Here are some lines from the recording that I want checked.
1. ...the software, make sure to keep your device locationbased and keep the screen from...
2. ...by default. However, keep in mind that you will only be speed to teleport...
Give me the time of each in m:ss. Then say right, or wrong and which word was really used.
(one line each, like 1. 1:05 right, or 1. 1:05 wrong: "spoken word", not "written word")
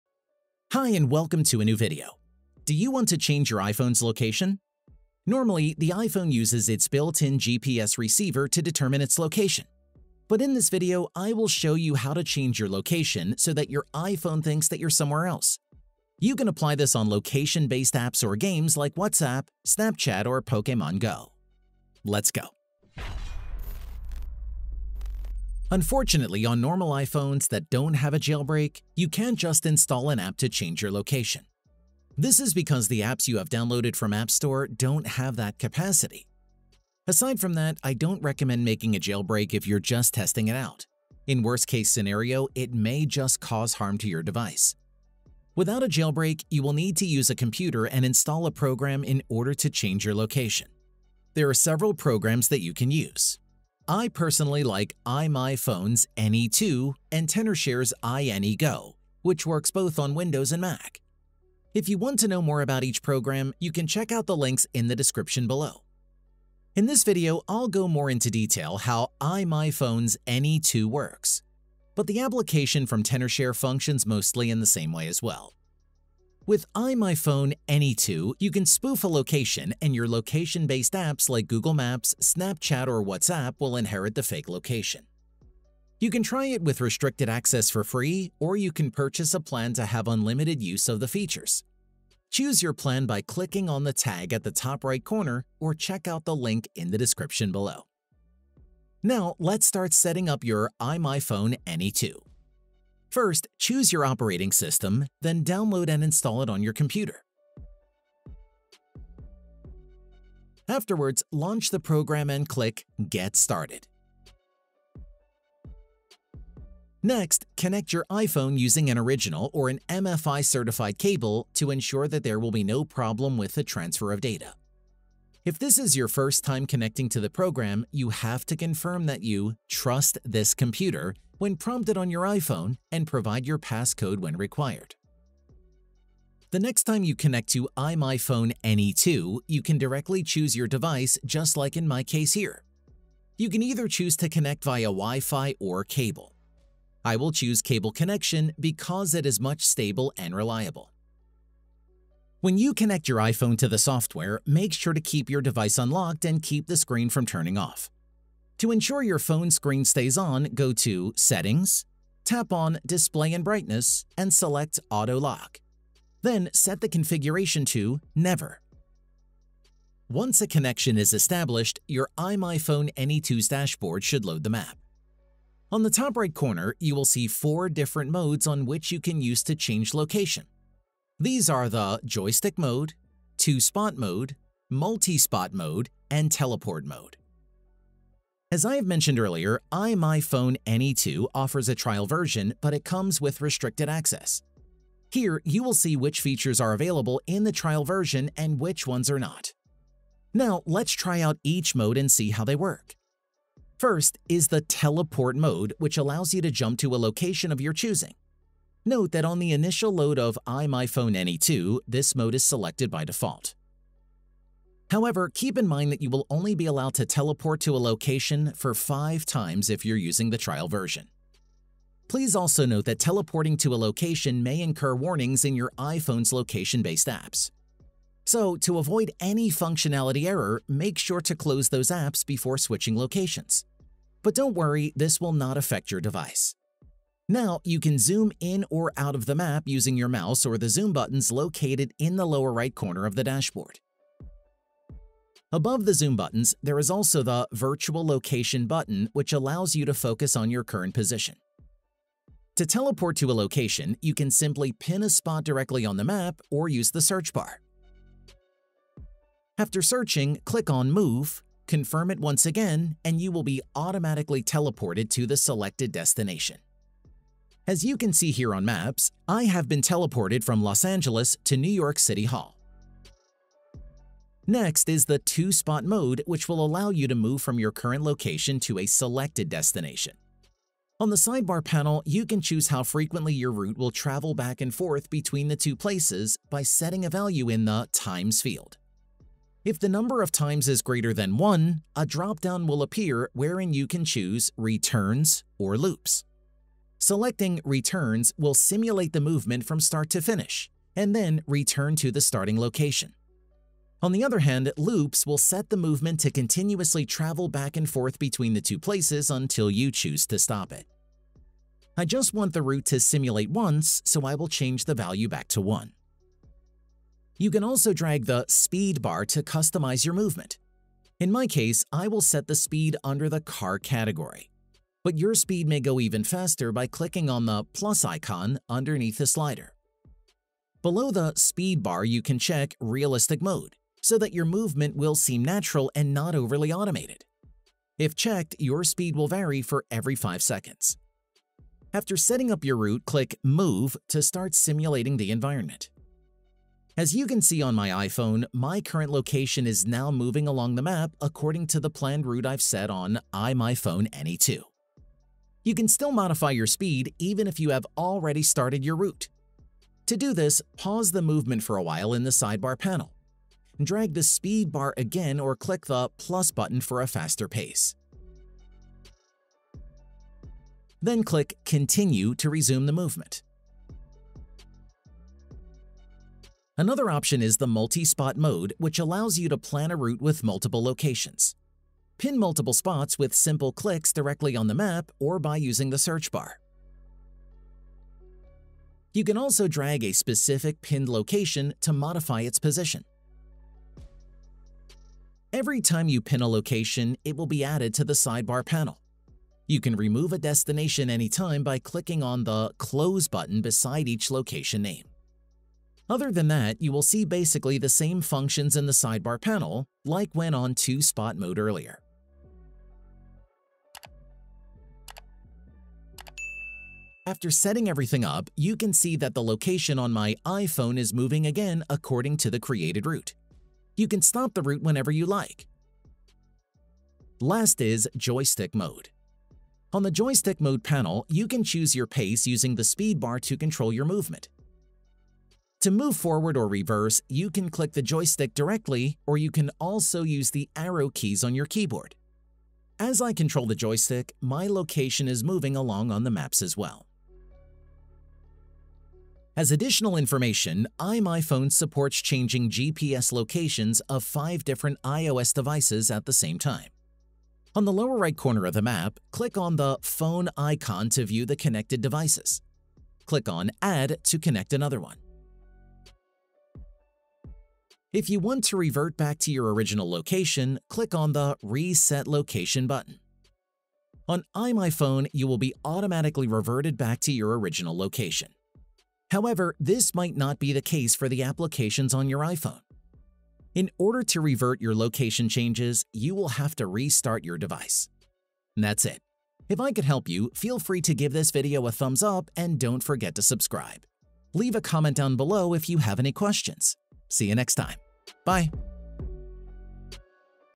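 1. 2:33 wrong: "unlocked", not "locationbased"
2. 3:32 wrong: "allowed", not "speed".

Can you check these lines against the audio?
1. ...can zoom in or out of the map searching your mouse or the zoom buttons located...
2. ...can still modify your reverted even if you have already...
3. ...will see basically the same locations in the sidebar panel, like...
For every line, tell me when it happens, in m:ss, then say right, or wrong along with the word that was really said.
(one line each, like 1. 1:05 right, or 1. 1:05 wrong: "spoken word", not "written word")
1. 3:57 wrong: "using", not "searching"
2. 5:55 wrong: "speed", not "reverted"
3. 6:46 wrong: "functions", not "locations".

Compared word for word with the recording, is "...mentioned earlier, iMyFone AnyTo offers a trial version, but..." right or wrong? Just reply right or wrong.
right.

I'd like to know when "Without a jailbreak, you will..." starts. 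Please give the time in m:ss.
0:45.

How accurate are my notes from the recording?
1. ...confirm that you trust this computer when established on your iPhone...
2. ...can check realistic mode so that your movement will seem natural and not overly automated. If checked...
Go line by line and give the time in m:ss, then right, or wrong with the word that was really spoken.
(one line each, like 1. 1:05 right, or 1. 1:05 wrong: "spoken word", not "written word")
1. 2:08 wrong: "prompted", not "established"
2. 5:32 right.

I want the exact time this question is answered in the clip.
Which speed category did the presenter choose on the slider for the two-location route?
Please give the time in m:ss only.
5:23.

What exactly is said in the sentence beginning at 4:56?
Selecting Returns will simulate the movement from start to finish, and then return to the starting location.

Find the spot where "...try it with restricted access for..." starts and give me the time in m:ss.
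1:26.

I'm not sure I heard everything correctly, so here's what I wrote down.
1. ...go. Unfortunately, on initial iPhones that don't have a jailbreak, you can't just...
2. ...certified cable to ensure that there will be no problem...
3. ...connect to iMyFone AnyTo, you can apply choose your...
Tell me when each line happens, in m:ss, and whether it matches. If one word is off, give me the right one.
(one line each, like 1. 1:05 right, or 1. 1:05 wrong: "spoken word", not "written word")
1. 0:22 wrong: "normal", not "initial"
2. 2:00 right
3. 2:17 wrong: "directly", not "apply".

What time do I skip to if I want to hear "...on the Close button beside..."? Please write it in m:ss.
6:42.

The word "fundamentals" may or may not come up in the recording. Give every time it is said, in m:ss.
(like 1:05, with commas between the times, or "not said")
not said.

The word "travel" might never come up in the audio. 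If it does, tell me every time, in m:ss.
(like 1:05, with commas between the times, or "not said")
4:43, 5:07.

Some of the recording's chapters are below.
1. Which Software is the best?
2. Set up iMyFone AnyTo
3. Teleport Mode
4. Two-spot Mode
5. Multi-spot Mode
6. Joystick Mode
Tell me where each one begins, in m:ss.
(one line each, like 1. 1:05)
1. 0:24
2. 1:38
3. 3:20
4. 4:34
5. 6:16
6. 7:07.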